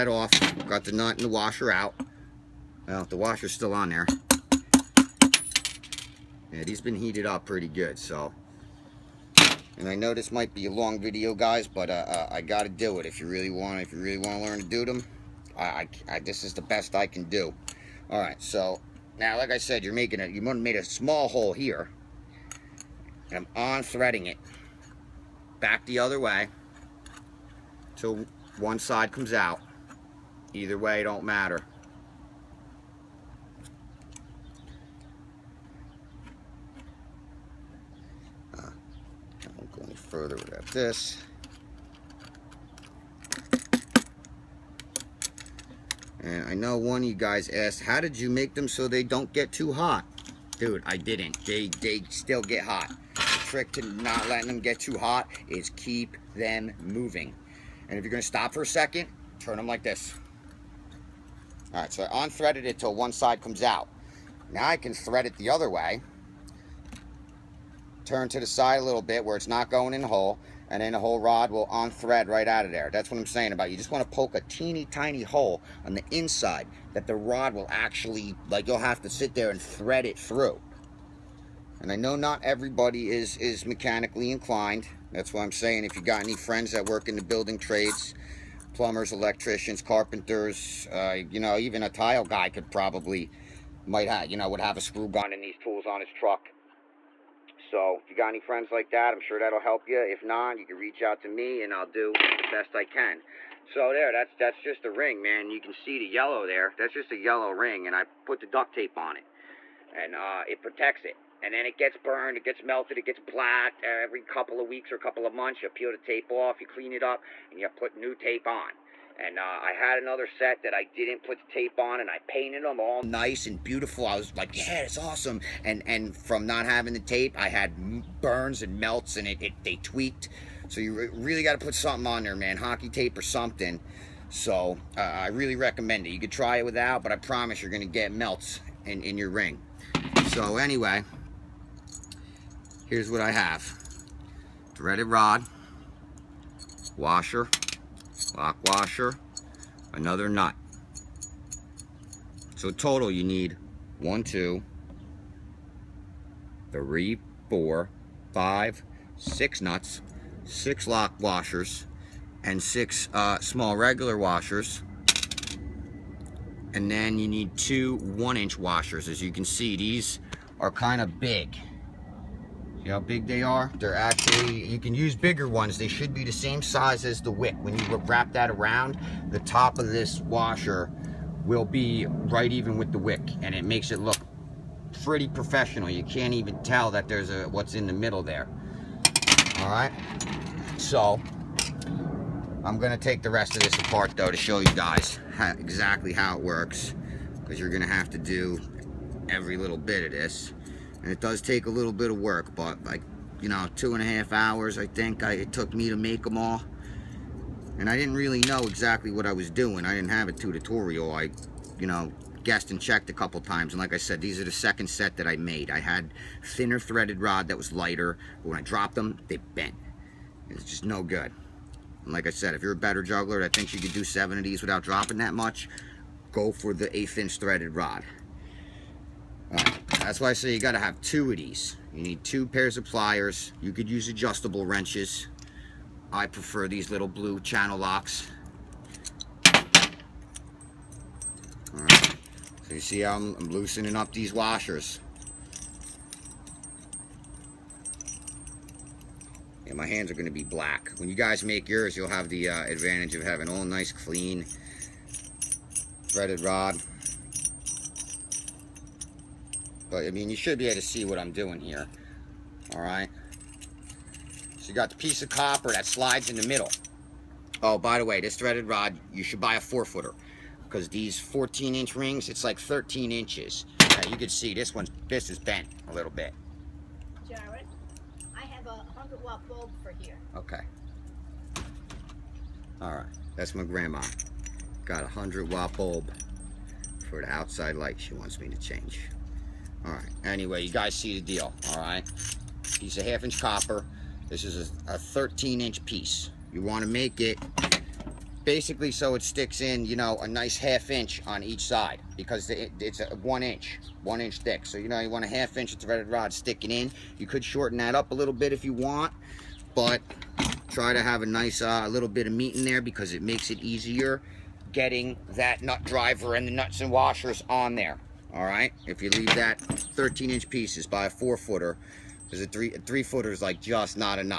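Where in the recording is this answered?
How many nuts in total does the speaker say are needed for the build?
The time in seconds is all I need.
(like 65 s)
159 s.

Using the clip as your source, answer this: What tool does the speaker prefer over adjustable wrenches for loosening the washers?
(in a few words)
Little blue channel locks.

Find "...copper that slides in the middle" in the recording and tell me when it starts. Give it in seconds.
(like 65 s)
265 s.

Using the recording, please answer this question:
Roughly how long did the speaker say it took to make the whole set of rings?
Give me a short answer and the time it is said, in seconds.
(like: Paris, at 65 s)
2.5 hours, at 203 s.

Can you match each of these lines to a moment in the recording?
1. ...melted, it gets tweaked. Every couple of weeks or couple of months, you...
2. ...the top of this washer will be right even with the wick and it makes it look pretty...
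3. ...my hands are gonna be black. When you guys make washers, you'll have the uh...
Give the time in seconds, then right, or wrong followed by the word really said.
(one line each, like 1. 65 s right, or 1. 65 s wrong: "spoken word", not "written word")
1. 112 s wrong: "blacked", not "tweaked"
2. 179 s right
3. 249 s wrong: "yours", not "washers".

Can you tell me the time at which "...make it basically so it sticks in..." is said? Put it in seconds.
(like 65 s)
296 s.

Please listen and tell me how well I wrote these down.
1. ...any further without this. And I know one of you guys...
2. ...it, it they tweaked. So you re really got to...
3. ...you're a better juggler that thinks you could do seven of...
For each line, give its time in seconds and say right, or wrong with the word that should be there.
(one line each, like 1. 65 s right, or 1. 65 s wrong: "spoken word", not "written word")
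1. 39 s right
2. 129 s right
3. 222 s right.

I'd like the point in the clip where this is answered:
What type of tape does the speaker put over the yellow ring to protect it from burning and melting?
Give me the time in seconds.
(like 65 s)
108 s.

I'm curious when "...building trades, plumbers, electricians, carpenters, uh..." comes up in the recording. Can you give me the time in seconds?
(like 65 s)
87 s.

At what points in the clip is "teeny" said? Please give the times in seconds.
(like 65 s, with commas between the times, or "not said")
74 s.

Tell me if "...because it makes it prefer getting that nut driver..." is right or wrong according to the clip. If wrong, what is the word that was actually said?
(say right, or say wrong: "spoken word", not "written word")
wrong: "easier", not "prefer".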